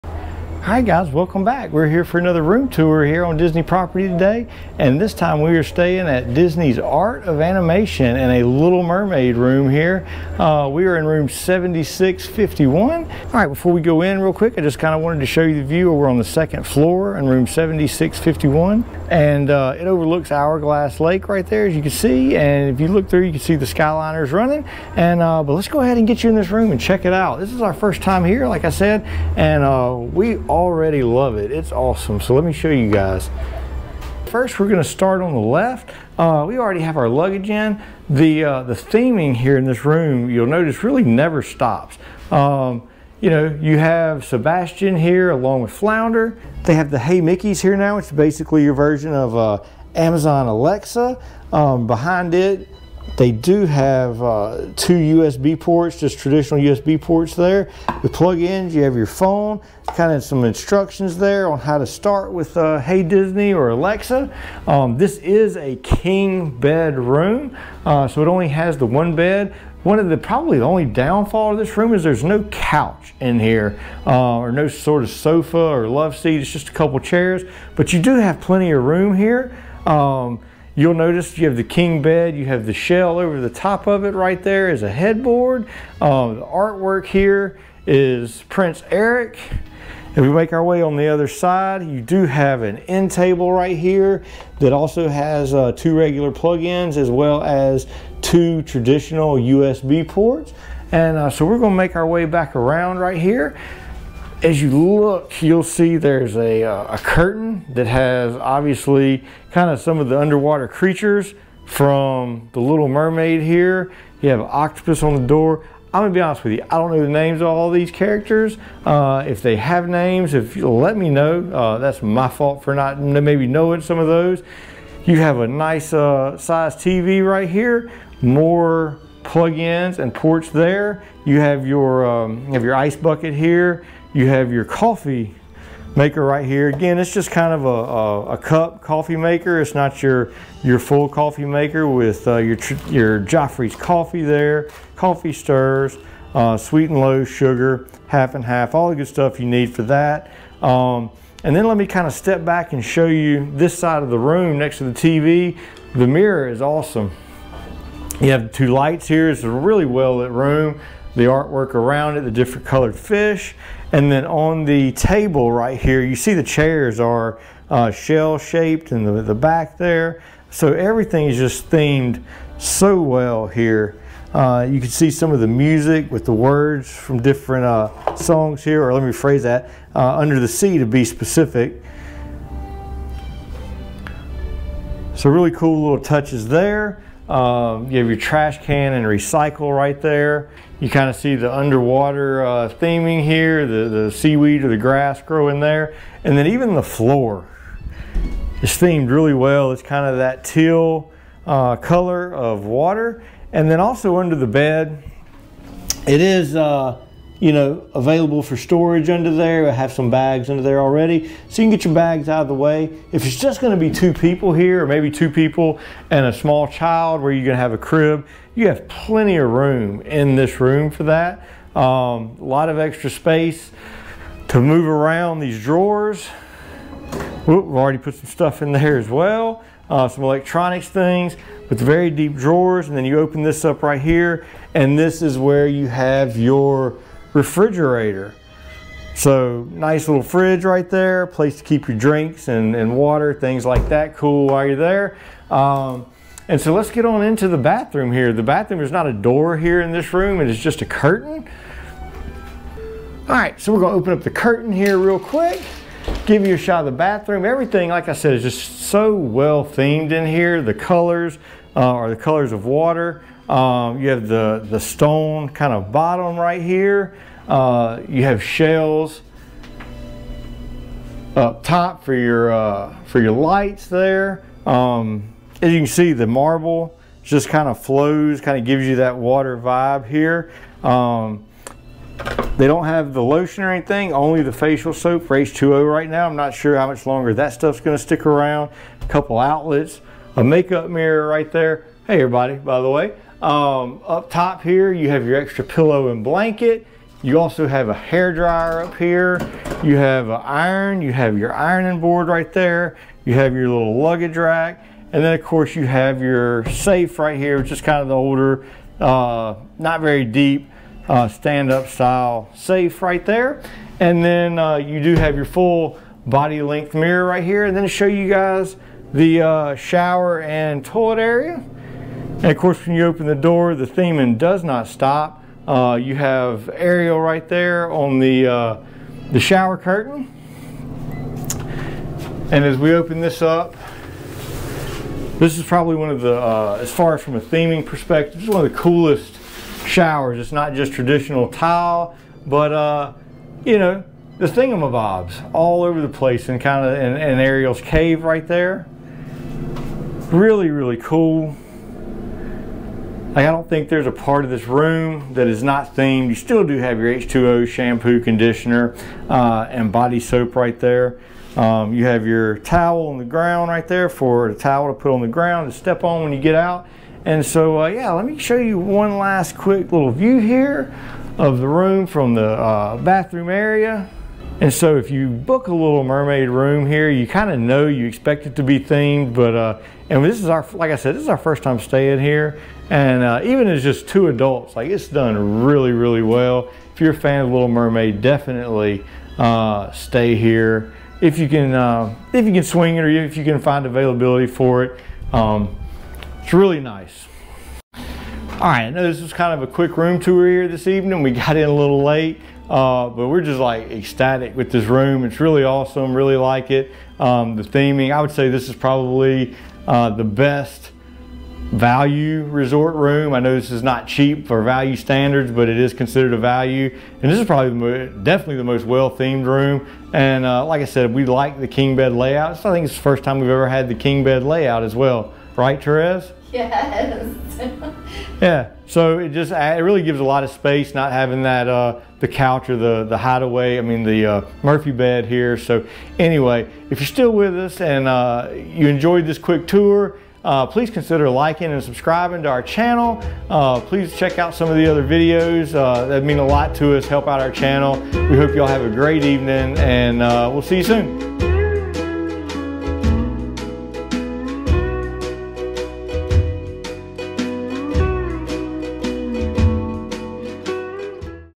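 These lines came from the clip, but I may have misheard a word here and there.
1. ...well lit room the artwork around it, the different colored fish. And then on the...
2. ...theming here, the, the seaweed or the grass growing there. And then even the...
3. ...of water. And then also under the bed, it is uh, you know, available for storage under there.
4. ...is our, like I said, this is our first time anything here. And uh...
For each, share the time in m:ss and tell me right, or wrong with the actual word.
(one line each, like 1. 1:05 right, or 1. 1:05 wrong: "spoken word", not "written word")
1. 2:39 right
2. 3:12 right
3. 3:22 right
4. 6:20 wrong: "staying", not "anything".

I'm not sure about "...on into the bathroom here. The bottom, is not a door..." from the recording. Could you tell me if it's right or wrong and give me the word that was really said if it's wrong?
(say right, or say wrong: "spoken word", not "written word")
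wrong: "bathroom", not "bottom".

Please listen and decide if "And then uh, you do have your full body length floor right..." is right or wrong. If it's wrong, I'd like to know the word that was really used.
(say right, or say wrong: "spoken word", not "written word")
wrong: "mirror", not "floor".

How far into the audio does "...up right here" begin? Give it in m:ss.
3:53.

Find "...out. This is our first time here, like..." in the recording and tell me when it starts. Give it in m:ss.
0:27.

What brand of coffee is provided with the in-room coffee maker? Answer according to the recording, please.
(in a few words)
Joffrey's.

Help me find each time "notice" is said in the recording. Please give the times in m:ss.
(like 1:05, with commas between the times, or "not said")
0:40, 1:20.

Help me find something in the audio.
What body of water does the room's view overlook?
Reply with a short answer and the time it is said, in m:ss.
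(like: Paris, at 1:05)
Hourglass Lake, at 0:20.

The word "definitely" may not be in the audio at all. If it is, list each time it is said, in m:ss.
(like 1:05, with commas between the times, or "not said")
6:28, 6:58.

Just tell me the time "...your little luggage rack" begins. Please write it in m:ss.
5:03.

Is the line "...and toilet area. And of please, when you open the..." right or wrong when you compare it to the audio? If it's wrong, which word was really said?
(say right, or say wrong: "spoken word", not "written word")
wrong: "course", not "please".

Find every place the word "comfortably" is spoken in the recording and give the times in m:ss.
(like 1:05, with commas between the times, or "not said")
not said.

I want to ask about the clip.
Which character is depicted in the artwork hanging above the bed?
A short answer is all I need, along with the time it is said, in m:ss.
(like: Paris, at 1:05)
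Prince Eric, at 1:28.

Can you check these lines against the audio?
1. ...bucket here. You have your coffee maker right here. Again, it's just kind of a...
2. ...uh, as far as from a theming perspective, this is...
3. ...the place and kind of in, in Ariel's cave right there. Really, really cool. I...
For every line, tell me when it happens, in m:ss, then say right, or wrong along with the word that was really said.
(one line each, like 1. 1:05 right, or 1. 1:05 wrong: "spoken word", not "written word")
1. 2:12 right
2. 5:36 right
3. 5:46 right.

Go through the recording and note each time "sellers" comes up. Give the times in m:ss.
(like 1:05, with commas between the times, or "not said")
not said.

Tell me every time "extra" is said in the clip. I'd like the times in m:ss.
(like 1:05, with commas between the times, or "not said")
3:42, 4:55.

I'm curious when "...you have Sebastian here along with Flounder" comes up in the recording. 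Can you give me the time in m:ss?
0:43.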